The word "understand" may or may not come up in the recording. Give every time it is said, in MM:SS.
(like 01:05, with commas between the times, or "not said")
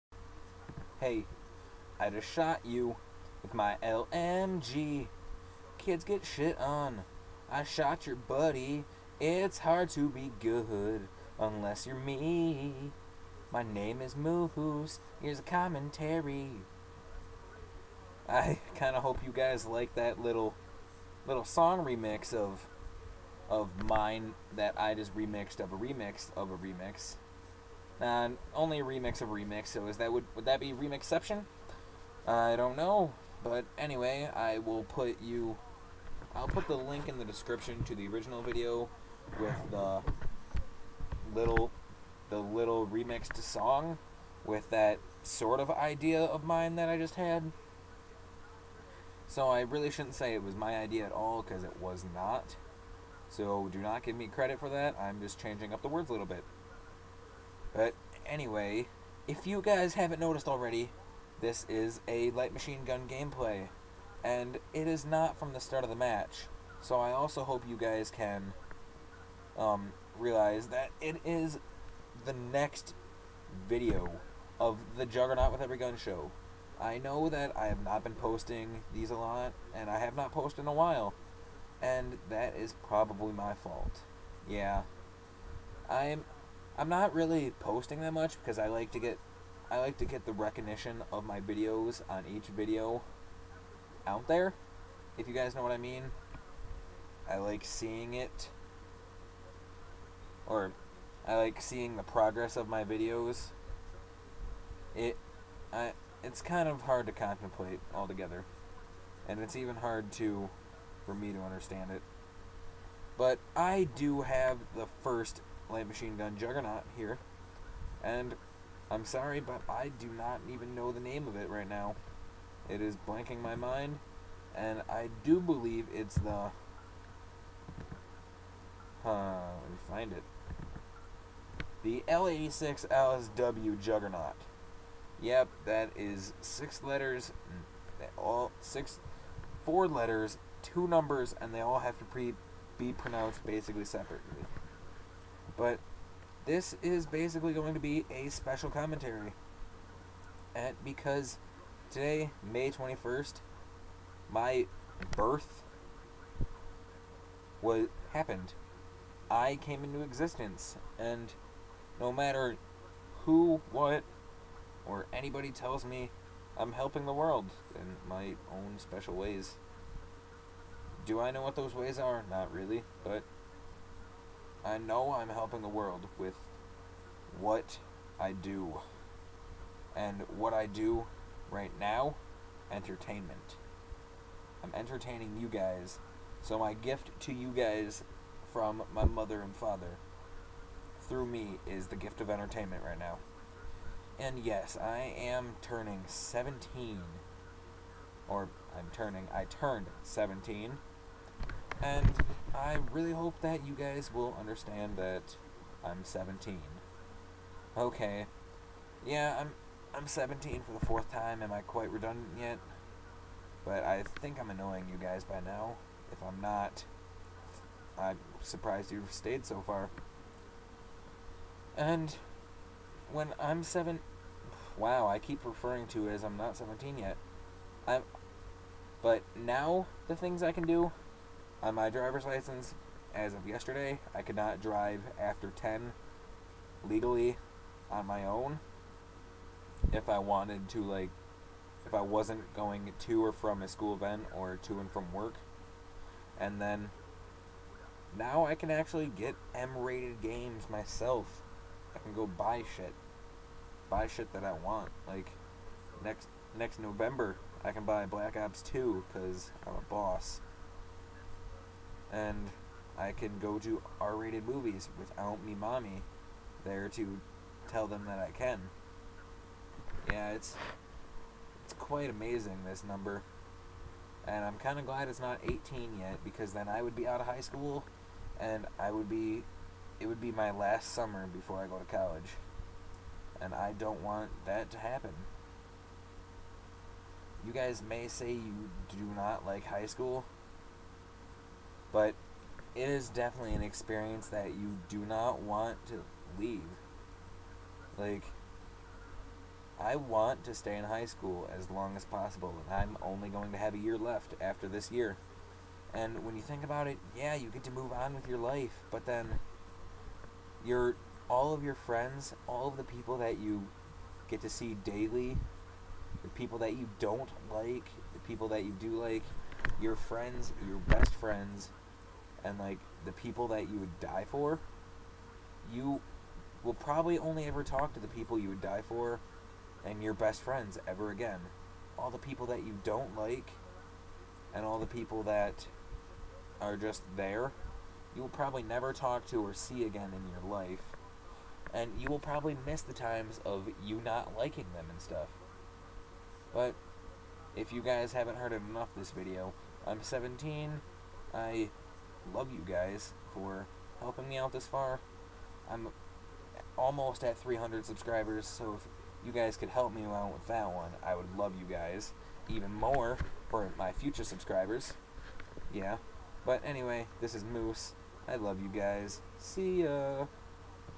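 01:51, 03:24.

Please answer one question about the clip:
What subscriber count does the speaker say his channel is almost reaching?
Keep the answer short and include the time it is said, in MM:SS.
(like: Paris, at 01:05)
300, at 05:57.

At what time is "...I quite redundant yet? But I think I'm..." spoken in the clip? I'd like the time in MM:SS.
03:31.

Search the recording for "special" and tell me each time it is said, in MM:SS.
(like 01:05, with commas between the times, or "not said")
02:28, 02:48.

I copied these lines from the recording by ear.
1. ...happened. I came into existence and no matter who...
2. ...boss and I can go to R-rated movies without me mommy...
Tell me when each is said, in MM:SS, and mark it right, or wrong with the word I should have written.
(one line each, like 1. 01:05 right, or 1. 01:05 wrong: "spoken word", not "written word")
1. 02:38 right
2. 04:19 right.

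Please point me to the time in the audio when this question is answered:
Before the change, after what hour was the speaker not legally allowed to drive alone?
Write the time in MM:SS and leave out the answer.
03:55.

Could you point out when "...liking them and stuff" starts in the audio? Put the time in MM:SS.
05:44.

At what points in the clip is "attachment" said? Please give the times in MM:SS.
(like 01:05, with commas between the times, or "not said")
not said.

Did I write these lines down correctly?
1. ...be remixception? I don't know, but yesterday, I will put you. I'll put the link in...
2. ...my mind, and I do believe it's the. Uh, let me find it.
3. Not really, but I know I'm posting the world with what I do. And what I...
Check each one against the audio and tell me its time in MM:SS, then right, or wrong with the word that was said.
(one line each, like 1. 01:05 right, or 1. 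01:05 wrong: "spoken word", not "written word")
1. 00:30 wrong: "anyway", not "yesterday"
2. 02:03 right
3. 02:52 wrong: "helping", not "posting".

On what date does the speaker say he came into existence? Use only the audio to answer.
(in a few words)
May 21st.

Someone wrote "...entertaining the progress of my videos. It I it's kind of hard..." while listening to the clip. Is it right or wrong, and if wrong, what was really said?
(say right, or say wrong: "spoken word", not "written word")
wrong: "seeing", not "entertaining".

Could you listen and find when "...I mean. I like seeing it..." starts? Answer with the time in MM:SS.
01:35.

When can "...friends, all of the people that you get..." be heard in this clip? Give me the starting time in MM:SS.
05:11.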